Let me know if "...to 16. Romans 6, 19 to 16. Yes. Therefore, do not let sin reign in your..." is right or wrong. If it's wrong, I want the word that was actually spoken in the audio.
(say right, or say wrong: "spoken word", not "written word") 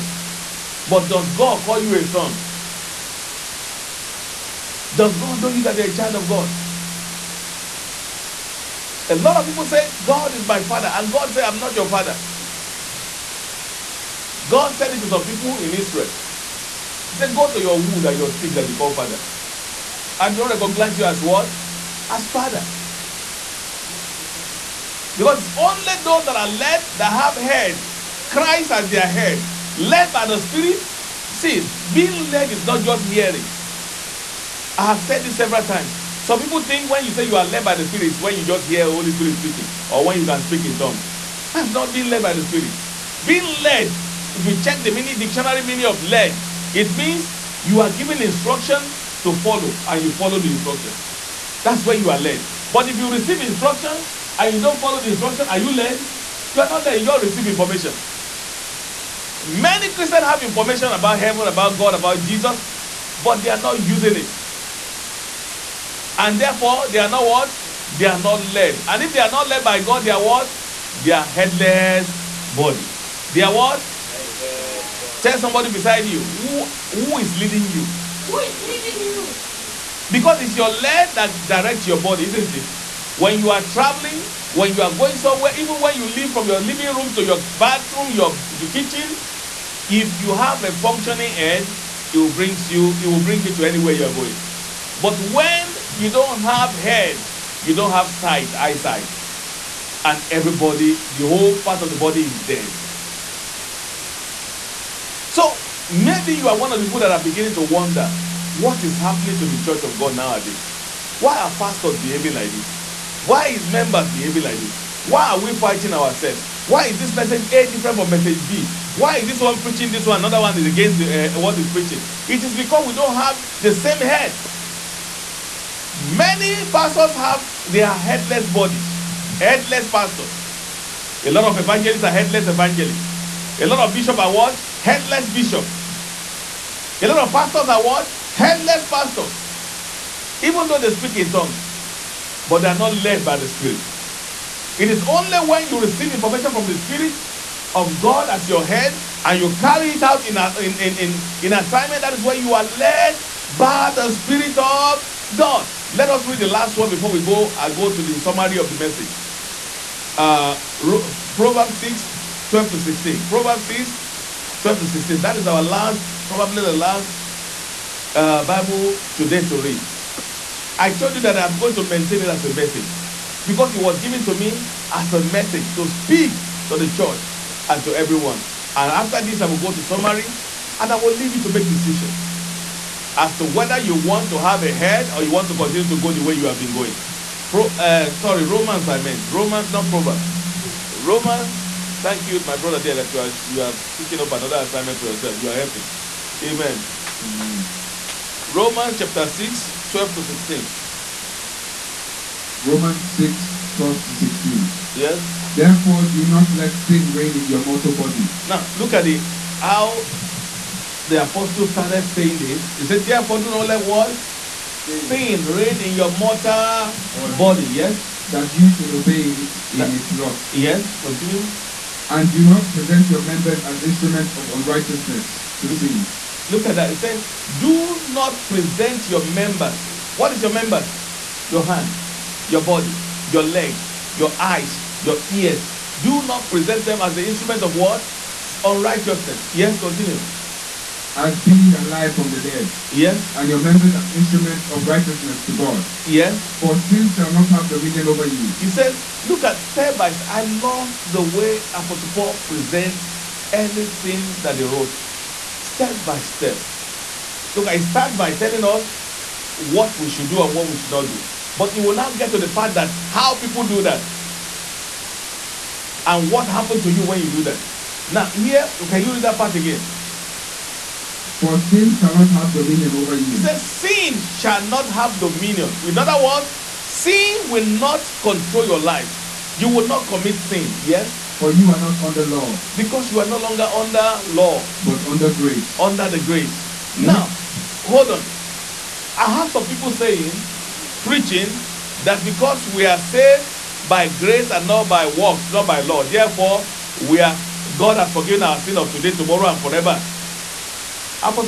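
wrong: "12", not "19".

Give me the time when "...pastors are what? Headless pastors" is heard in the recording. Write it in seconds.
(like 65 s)
137 s.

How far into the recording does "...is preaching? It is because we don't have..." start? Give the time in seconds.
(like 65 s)
121 s.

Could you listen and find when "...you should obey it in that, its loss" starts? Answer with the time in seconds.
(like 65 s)
218 s.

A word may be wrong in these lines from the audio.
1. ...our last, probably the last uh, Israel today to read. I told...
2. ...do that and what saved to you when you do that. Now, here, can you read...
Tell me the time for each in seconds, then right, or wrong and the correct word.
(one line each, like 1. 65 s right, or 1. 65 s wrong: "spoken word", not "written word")
1. 165 s wrong: "Bible", not "Israel"
2. 263 s wrong: "happened", not "saved".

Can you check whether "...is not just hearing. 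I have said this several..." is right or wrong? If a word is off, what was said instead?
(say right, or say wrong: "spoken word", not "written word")
right.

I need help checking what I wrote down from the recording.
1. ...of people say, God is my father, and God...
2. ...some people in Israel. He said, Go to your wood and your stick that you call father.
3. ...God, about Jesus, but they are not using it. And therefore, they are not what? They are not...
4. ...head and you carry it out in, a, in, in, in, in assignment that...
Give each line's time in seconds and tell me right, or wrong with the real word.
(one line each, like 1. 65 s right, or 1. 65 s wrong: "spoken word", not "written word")
1. 9 s right
2. 15 s right
3. 61 s right
4. 148 s right.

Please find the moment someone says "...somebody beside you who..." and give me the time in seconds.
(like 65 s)
75 s.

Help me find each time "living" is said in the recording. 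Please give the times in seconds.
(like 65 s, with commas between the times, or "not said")
86 s.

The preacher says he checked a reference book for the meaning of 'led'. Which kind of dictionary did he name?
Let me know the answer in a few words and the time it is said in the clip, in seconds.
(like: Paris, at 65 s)
Mini dictionary, at 44 s.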